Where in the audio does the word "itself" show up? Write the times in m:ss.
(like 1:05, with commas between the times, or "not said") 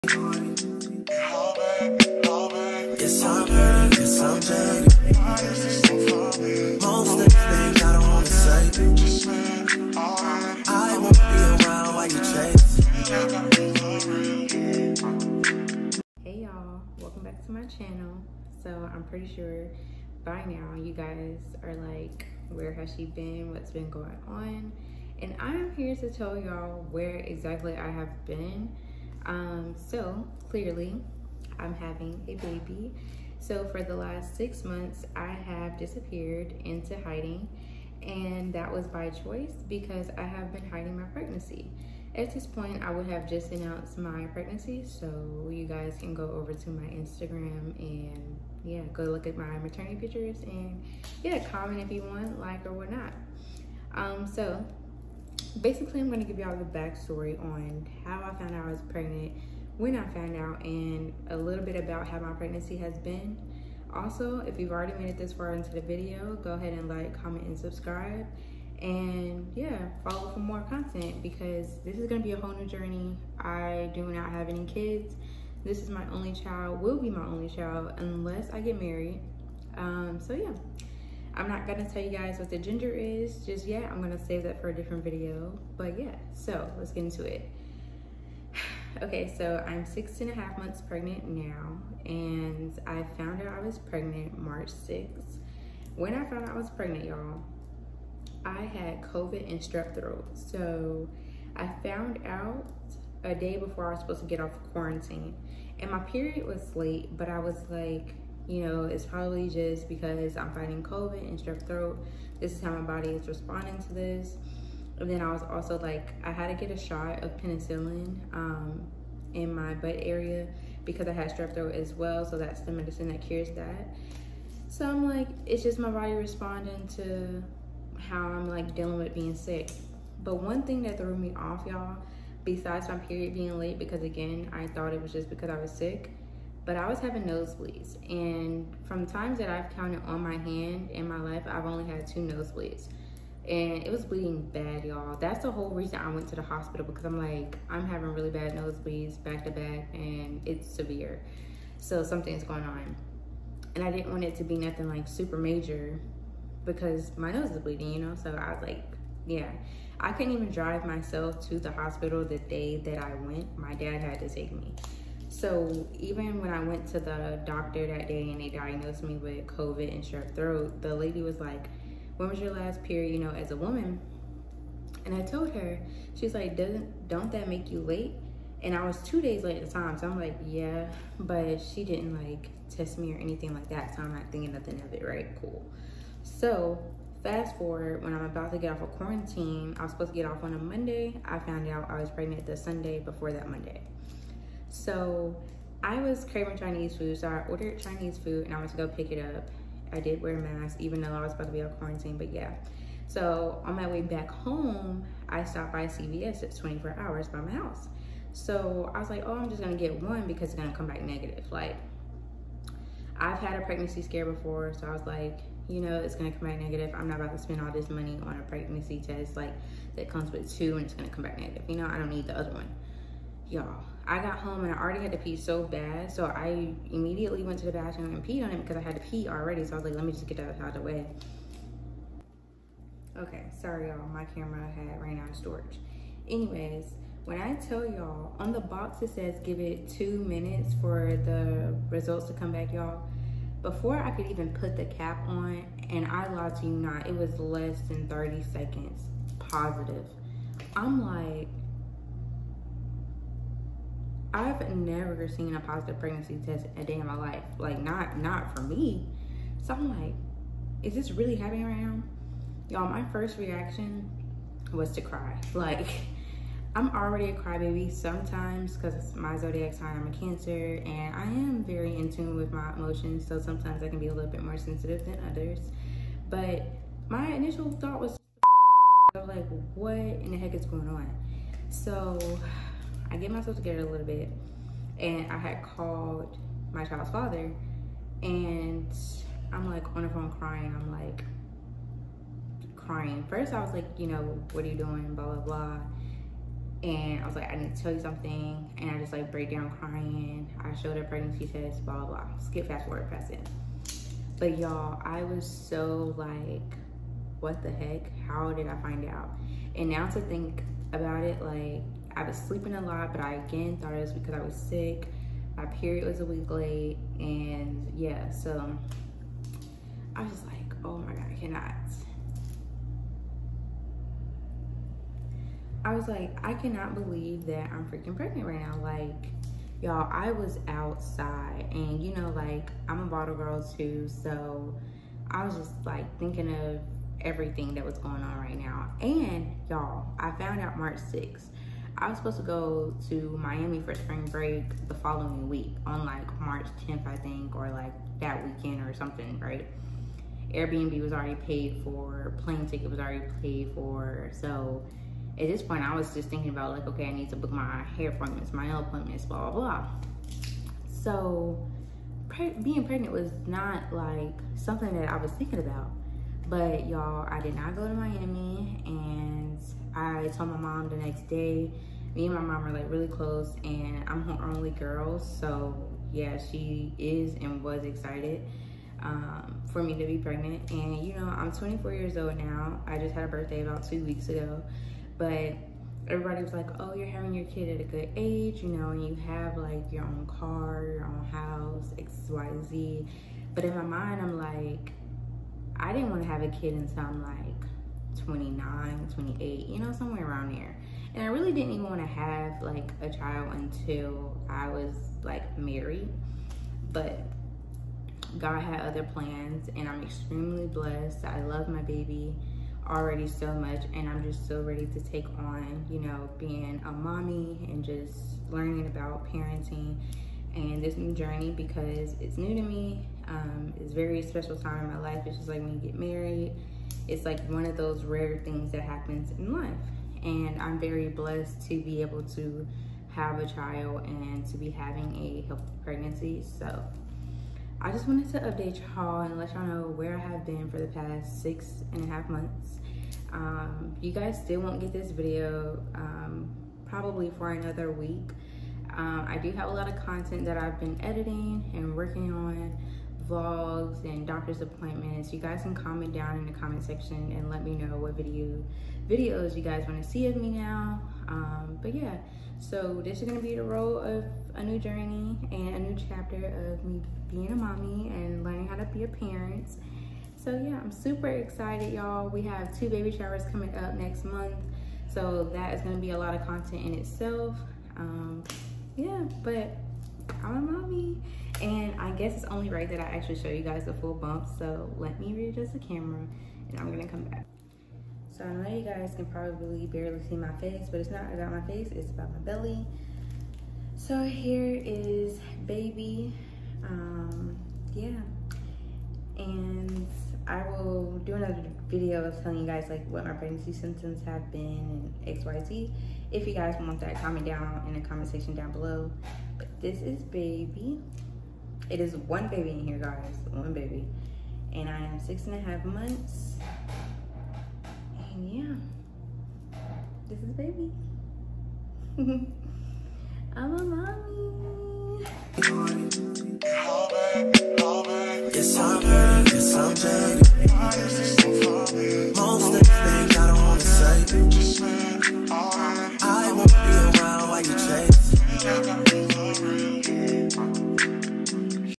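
7:56.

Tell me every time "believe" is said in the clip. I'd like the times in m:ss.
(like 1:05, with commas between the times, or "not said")
5:26.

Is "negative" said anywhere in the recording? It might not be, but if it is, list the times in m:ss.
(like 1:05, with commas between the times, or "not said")
3:31, 3:36, 3:41.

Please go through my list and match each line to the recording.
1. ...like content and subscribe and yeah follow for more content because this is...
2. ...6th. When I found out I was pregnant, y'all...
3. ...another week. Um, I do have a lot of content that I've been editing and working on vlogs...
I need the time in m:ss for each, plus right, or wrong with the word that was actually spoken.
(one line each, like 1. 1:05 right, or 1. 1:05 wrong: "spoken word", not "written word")
1. 1:06 wrong: "comment", not "content"
2. 1:34 right
3. 7:27 right.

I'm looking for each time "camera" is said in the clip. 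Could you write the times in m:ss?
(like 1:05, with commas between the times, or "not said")
3:54, 8:05.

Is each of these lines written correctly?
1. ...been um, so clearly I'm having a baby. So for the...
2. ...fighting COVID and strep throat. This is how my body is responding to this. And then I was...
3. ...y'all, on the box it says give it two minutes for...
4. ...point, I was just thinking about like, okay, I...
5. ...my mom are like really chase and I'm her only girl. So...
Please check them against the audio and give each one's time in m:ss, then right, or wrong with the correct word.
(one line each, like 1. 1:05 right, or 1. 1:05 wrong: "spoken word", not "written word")
1. 0:28 right
2. 1:50 right
3. 3:57 right
4. 5:55 right
5. 6:12 wrong: "close", not "chase".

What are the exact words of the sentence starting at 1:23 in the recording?
I'm gonna save that for a different video.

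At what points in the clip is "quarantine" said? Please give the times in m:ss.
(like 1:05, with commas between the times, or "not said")
1:44, 3:08, 3:21.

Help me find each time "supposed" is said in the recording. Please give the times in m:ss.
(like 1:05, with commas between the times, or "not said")
1:44, 3:09, 5:42.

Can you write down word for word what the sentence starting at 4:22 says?
Y'all, my first reaction was to cry.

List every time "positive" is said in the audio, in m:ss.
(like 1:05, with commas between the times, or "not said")
4:09, 4:15.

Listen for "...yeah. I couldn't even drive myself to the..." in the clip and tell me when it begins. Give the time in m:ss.
2:39.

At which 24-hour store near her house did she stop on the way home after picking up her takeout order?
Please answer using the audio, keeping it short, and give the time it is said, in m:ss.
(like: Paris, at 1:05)
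CVS, at 3:25.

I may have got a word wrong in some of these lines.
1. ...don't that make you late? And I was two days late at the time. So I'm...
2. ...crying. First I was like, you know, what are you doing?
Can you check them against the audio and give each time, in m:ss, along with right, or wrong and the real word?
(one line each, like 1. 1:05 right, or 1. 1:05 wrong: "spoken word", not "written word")
1. 2:57 right
2. 4:52 right.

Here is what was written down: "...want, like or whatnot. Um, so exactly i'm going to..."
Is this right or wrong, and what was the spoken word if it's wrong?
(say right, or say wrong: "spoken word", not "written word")
wrong: "basically", not "exactly".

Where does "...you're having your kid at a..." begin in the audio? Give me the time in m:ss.
6:26.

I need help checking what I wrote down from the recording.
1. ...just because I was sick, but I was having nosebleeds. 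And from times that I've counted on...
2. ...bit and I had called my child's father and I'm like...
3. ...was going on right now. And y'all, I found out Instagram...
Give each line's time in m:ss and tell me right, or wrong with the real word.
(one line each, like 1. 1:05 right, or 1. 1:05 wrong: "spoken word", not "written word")
1. 2:15 right
2. 4:44 right
3. 5:37 wrong: "March", not "Instagram".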